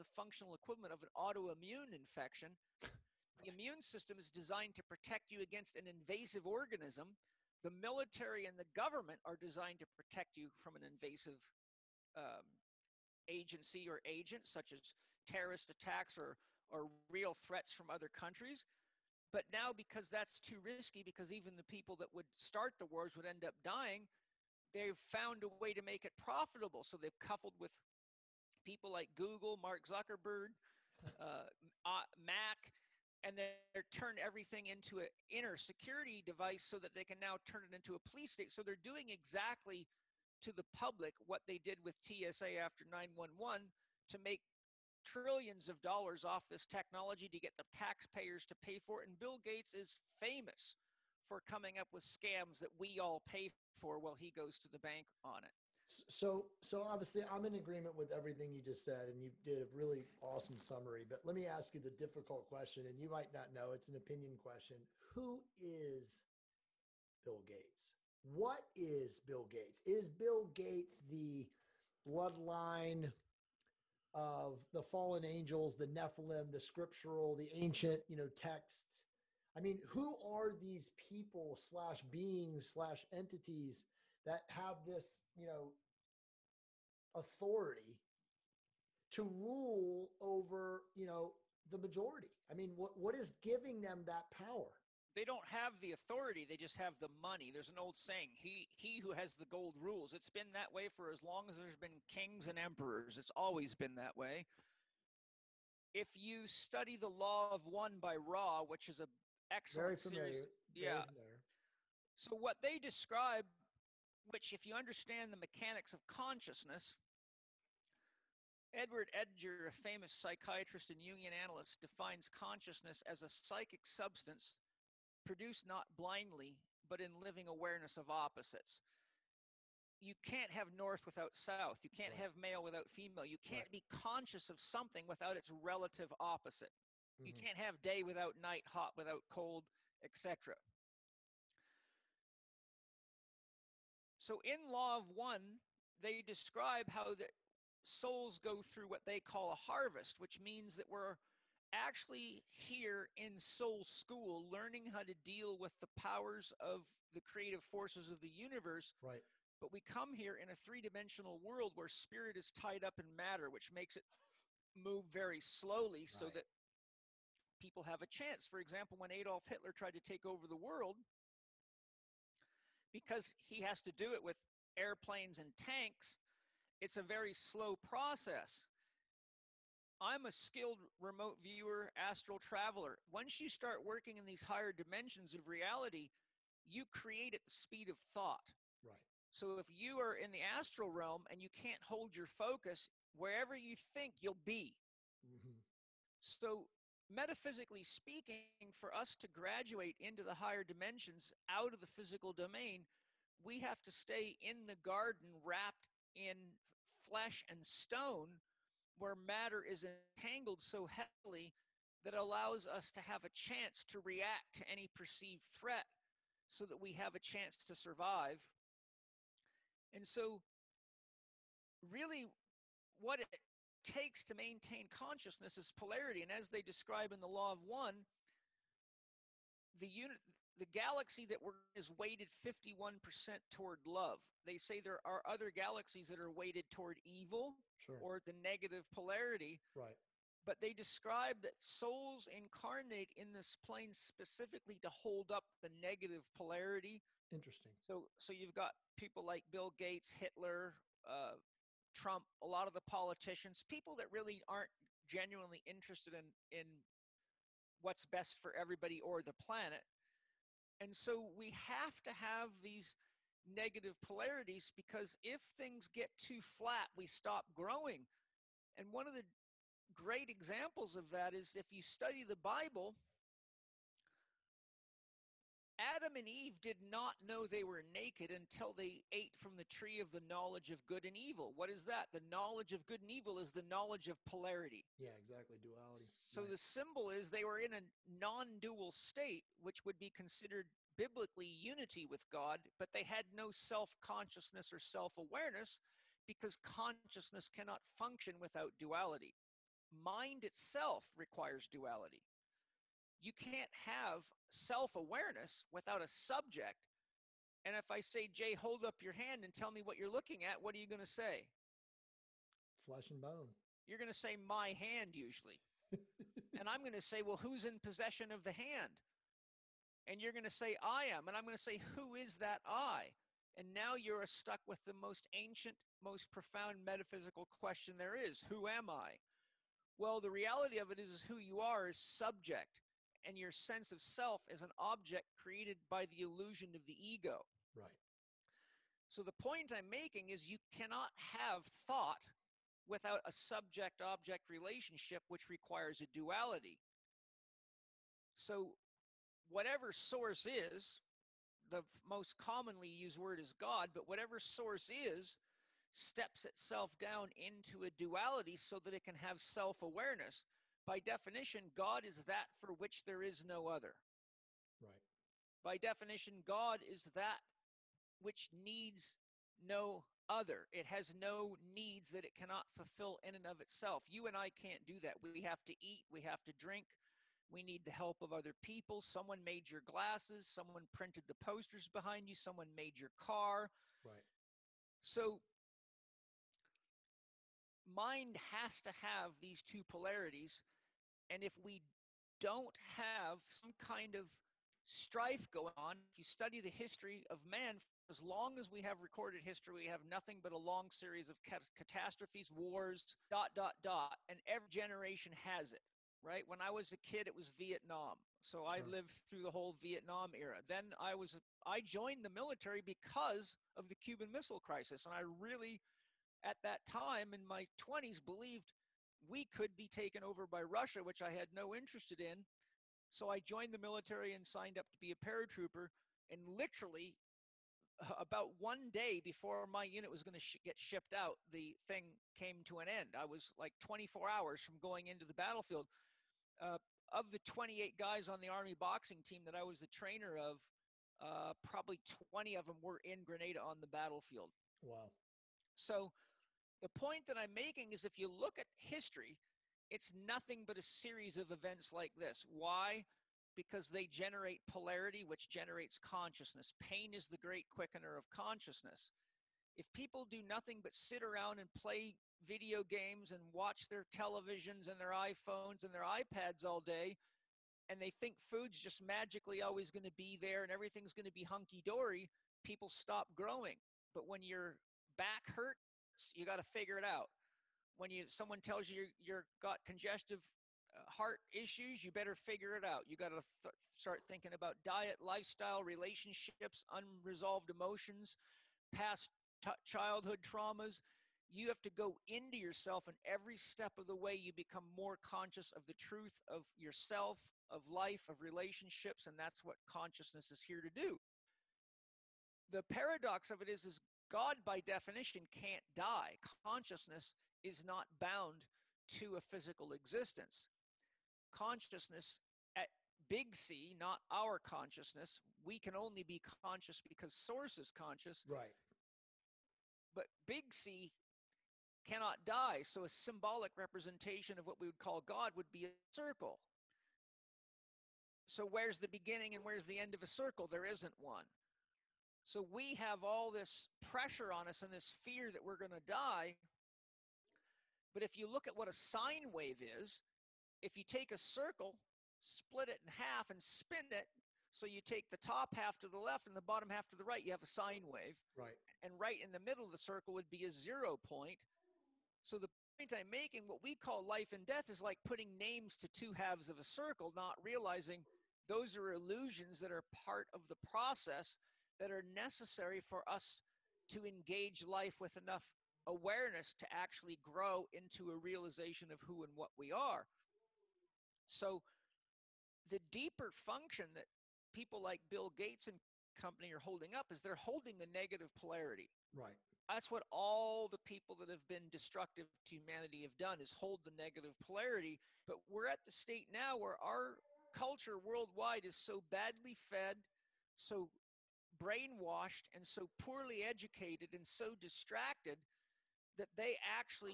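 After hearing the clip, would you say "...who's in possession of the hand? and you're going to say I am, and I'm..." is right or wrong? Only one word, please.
right.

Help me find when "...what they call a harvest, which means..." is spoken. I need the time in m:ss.
2:28.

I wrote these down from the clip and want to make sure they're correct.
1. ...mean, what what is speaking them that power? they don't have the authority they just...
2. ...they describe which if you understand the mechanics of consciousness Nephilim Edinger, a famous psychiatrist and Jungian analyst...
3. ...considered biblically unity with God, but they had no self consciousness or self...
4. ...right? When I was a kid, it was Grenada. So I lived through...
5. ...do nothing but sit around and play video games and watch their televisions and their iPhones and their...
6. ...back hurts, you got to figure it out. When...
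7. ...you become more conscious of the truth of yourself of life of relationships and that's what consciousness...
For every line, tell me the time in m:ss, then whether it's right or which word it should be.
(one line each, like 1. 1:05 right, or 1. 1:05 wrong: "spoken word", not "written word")
1. 1:32 wrong: "giving", not "speaking"
2. 1:52 wrong: "Edward", not "Nephilim"
3. 4:50 right
4. 6:46 wrong: "Vietnam", not "Grenada"
5. 7:40 right
6. 7:55 right
7. 8:14 right.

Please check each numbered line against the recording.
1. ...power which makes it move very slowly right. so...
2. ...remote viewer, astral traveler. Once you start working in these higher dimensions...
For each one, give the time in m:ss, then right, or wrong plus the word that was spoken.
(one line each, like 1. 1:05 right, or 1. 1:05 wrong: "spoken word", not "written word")
1. 2:43 wrong: "matter", not "power"
2. 3:00 right.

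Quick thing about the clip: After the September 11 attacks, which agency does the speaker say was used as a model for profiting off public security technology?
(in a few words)
TSA.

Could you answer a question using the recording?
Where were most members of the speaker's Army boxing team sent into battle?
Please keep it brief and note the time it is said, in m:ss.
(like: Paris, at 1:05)
Grenada, at 7:23.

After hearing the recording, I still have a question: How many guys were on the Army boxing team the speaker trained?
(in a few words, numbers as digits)
28.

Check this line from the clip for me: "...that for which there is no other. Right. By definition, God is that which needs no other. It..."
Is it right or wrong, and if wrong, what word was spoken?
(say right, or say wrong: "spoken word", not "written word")
right.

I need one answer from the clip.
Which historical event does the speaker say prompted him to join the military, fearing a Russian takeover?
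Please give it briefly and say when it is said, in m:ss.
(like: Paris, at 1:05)
Cuban Missile Crisis, at 6:53.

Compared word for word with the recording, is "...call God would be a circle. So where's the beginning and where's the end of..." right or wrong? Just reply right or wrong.
right.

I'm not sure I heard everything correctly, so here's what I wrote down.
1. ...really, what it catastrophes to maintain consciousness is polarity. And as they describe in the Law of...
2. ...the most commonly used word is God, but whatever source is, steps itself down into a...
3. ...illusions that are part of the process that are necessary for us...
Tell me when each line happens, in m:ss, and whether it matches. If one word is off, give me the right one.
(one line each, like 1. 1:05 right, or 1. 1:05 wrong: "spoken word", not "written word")
1. 3:41 wrong: "takes", not "catastrophes"
2. 5:51 right
3. 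9:19 right.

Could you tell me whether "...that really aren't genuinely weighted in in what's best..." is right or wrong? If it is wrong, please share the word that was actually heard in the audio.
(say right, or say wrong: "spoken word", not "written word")
wrong: "interested", not "weighted".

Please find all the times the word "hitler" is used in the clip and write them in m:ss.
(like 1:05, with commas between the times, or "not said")
2:49, 4:10.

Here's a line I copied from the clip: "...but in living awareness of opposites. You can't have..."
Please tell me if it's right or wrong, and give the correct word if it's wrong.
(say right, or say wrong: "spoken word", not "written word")
right.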